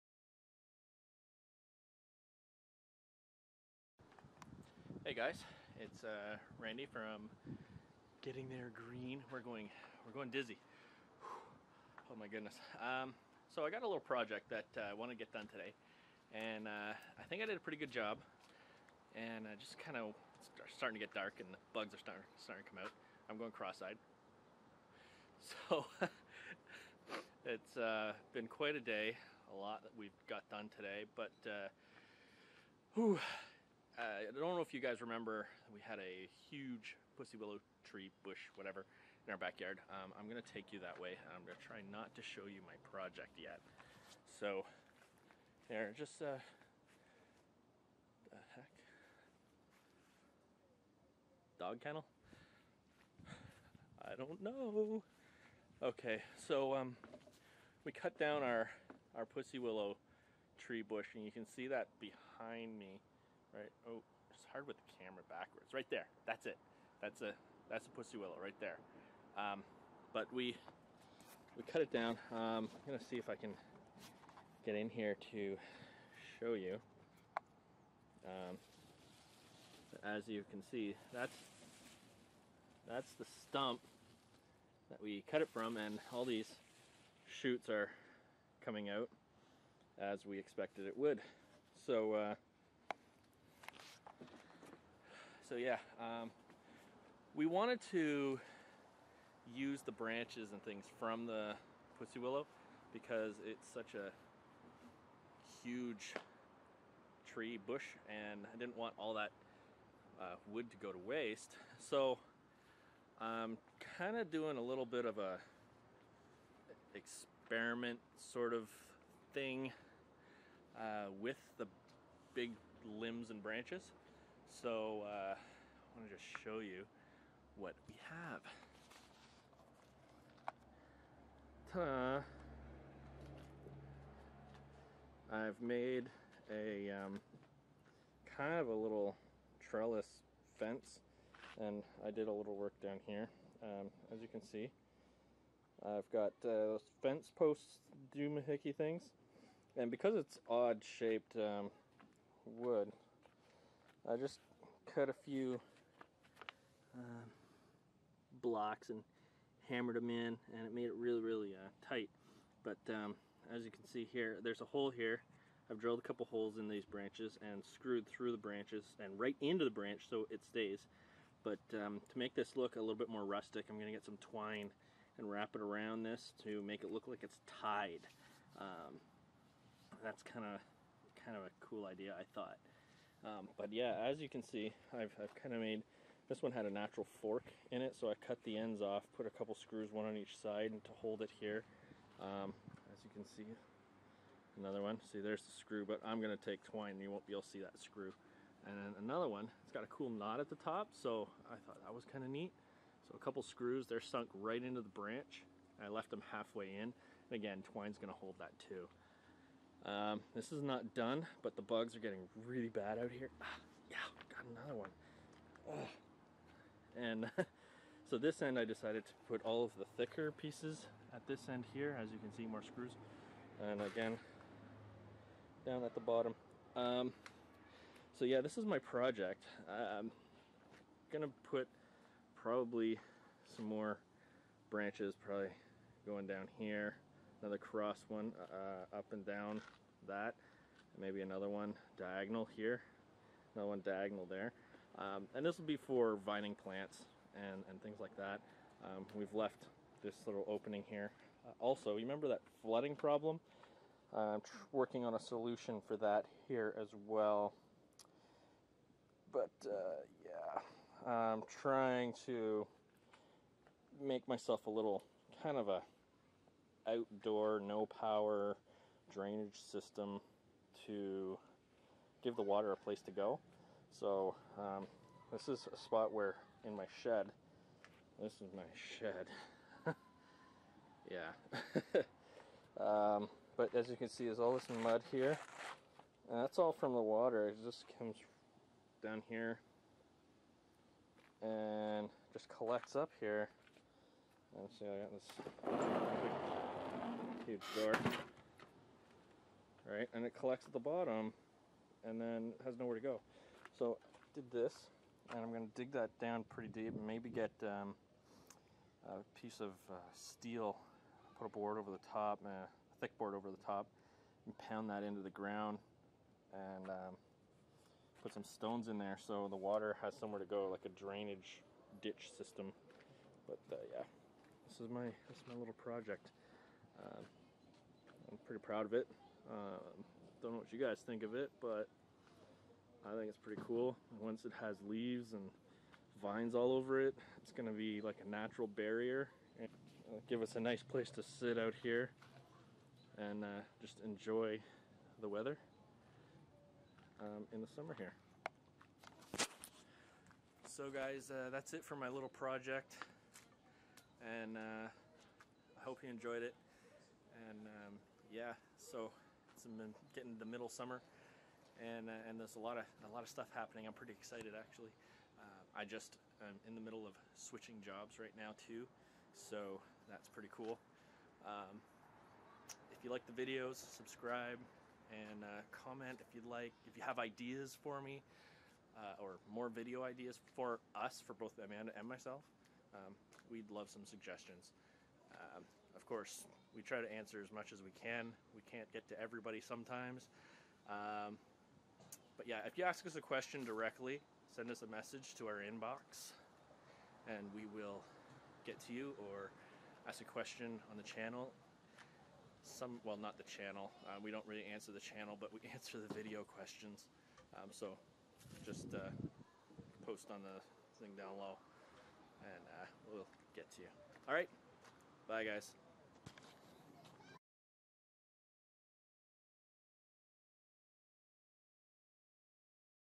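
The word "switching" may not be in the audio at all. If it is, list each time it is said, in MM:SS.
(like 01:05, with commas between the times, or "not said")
06:07.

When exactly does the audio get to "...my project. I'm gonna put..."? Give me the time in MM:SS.
03:48.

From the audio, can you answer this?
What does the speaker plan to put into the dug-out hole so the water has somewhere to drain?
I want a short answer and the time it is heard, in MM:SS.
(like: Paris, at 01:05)
Stones, at 05:18.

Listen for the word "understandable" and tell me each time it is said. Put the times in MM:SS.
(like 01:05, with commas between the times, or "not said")
not said.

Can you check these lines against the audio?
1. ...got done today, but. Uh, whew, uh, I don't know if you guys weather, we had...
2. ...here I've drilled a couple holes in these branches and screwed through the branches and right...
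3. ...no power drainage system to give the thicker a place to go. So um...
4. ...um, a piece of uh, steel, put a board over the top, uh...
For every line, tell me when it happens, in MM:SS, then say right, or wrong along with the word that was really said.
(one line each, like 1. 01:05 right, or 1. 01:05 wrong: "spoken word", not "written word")
1. 00:30 wrong: "remember", not "weather"
2. 02:44 right
3. 04:27 wrong: "water", not "thicker"
4. 05:07 right.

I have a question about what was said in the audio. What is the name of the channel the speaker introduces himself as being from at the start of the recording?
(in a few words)
Getting There Green.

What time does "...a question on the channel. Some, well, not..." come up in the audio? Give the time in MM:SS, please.
06:40.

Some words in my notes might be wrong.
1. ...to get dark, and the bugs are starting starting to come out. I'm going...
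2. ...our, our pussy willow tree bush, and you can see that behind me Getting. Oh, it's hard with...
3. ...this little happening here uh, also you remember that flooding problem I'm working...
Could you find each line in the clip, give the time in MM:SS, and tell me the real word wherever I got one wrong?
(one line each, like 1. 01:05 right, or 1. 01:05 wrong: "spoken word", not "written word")
1. 00:20 right
2. 00:58 wrong: "Right", not "Getting"
3. 04:10 wrong: "opening", not "happening".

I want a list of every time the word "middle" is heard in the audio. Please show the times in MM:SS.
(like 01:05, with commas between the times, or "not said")
06:00, 06:06.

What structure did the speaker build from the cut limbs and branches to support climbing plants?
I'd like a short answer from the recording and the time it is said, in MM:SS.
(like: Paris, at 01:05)
Trellis fence, at 02:19.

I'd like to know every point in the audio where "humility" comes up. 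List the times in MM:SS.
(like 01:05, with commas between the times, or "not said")
not said.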